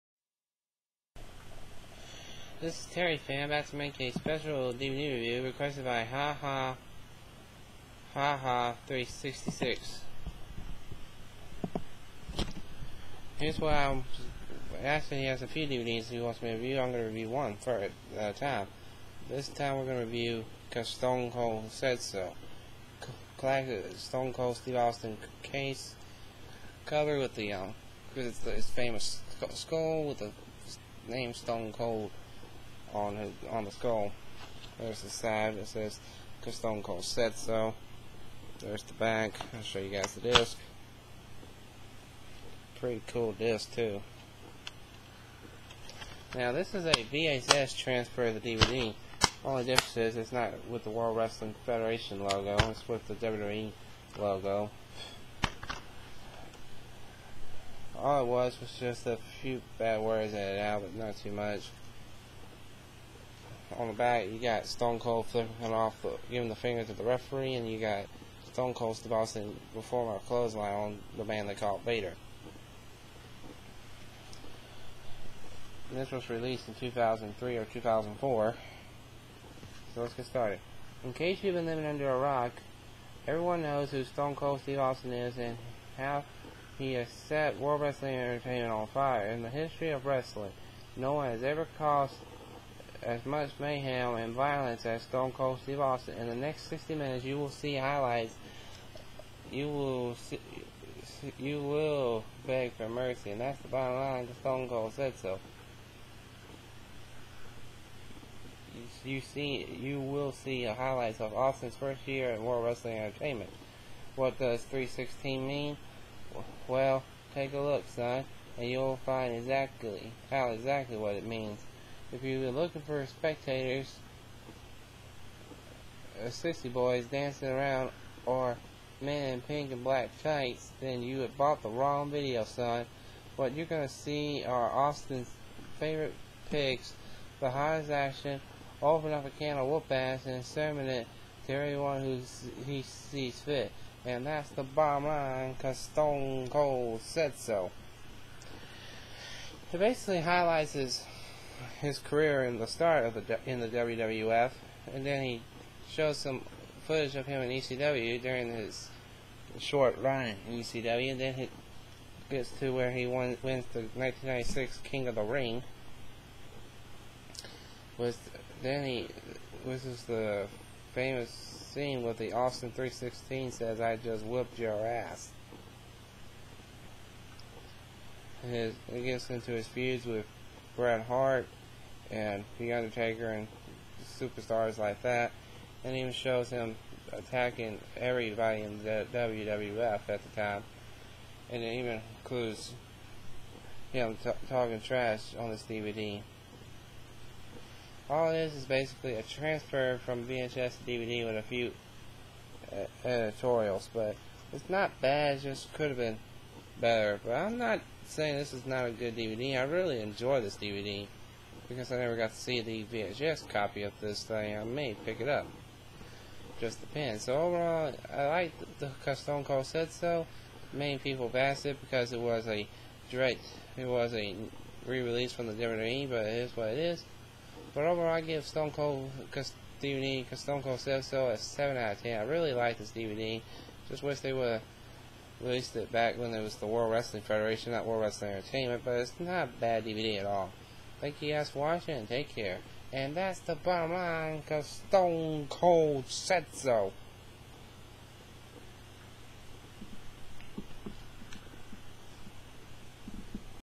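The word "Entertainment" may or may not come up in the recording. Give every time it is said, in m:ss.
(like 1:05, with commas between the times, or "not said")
1:28, 1:52, 3:58.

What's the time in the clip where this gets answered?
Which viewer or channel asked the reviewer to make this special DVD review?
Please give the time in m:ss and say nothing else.
0:06.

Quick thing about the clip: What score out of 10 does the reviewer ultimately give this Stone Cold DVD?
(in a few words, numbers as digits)
7.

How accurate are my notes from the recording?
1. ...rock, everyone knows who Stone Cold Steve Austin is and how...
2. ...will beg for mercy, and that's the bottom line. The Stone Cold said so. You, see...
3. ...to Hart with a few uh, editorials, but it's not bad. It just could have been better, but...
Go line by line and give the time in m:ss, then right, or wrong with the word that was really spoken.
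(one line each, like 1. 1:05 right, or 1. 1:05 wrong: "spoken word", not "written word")
1. 1:22 right
2. 1:41 right
3. 3:20 wrong: "DVD", not "Hart".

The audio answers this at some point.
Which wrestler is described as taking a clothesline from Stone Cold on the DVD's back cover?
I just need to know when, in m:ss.
1:11.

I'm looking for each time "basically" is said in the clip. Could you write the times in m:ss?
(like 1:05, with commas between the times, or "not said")
2:29, 3:18.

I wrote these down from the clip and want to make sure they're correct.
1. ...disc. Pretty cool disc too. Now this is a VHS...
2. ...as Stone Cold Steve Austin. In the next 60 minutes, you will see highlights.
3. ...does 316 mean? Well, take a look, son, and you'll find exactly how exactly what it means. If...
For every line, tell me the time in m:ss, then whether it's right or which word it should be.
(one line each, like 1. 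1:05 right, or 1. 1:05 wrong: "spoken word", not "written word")
1. 0:40 right
2. 1:34 right
3. 1:54 right.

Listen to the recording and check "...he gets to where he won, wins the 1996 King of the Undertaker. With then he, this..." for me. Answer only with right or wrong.
wrong.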